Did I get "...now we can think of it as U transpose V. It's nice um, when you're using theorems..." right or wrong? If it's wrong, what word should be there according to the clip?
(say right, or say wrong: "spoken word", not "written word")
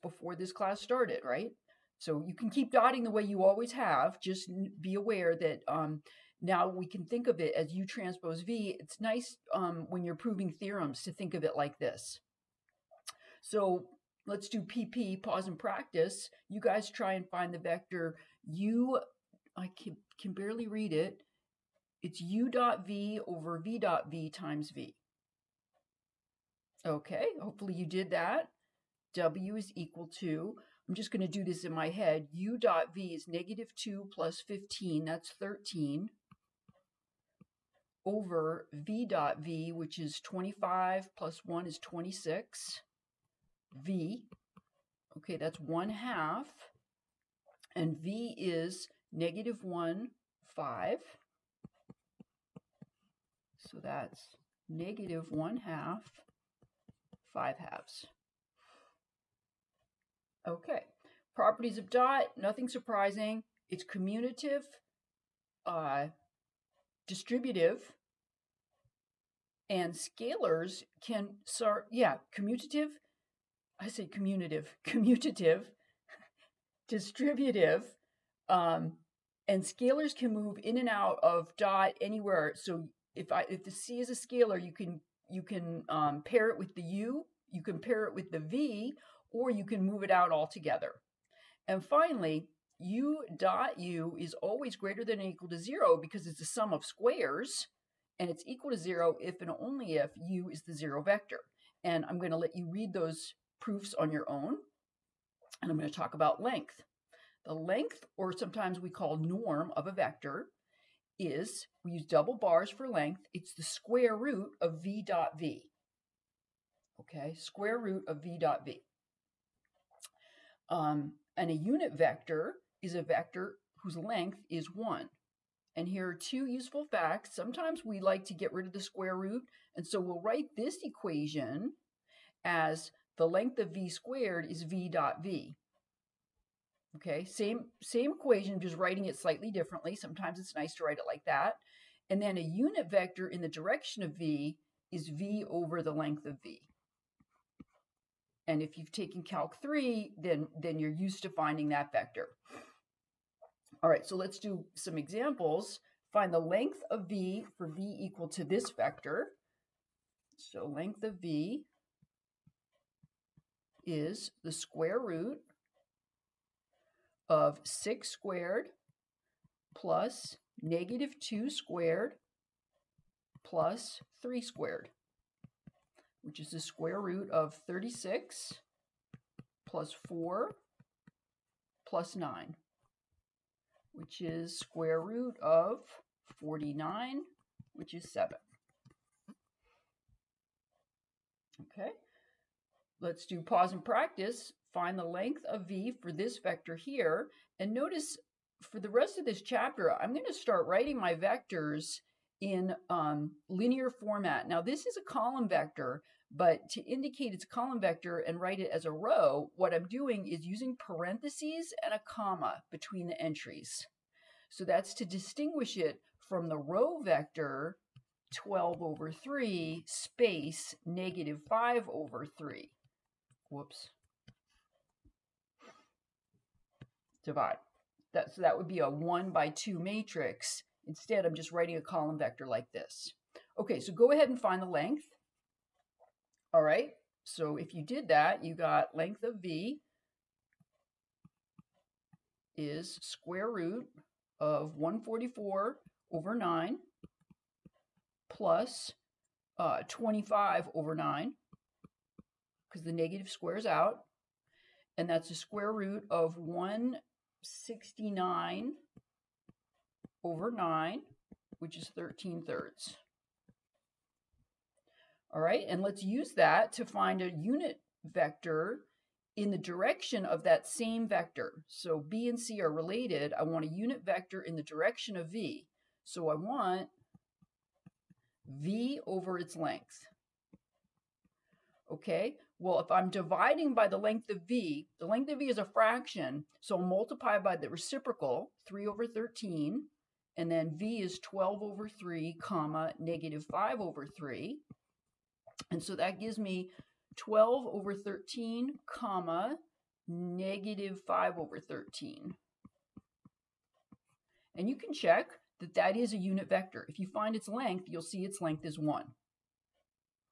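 wrong: "proving", not "using".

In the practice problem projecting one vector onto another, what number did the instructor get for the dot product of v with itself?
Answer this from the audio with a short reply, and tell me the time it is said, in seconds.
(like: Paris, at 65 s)
26, at 41 s.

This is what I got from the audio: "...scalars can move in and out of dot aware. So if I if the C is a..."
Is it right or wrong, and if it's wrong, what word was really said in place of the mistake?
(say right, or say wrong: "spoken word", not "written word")
wrong: "anywhere", not "aware".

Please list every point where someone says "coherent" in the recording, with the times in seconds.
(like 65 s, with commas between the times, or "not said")
not said.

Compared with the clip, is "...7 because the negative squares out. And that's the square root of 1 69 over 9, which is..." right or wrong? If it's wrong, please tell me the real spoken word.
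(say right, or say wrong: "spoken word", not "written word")
wrong: "9", not "7".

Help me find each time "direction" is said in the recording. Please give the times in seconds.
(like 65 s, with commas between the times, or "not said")
143 s, 269 s, 274 s.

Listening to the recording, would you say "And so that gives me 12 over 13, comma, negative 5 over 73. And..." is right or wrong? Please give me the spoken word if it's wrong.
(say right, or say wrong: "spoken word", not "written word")
wrong: "13", not "73".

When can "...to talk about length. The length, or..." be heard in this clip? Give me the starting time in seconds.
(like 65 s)
105 s.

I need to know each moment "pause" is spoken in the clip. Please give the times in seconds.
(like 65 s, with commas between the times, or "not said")
15 s, 193 s.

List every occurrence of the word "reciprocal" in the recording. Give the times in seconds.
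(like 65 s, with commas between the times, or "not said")
287 s.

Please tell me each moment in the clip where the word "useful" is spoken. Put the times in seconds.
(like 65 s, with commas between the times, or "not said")
126 s.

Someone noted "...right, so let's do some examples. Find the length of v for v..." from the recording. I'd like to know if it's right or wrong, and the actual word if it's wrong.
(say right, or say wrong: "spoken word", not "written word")
right.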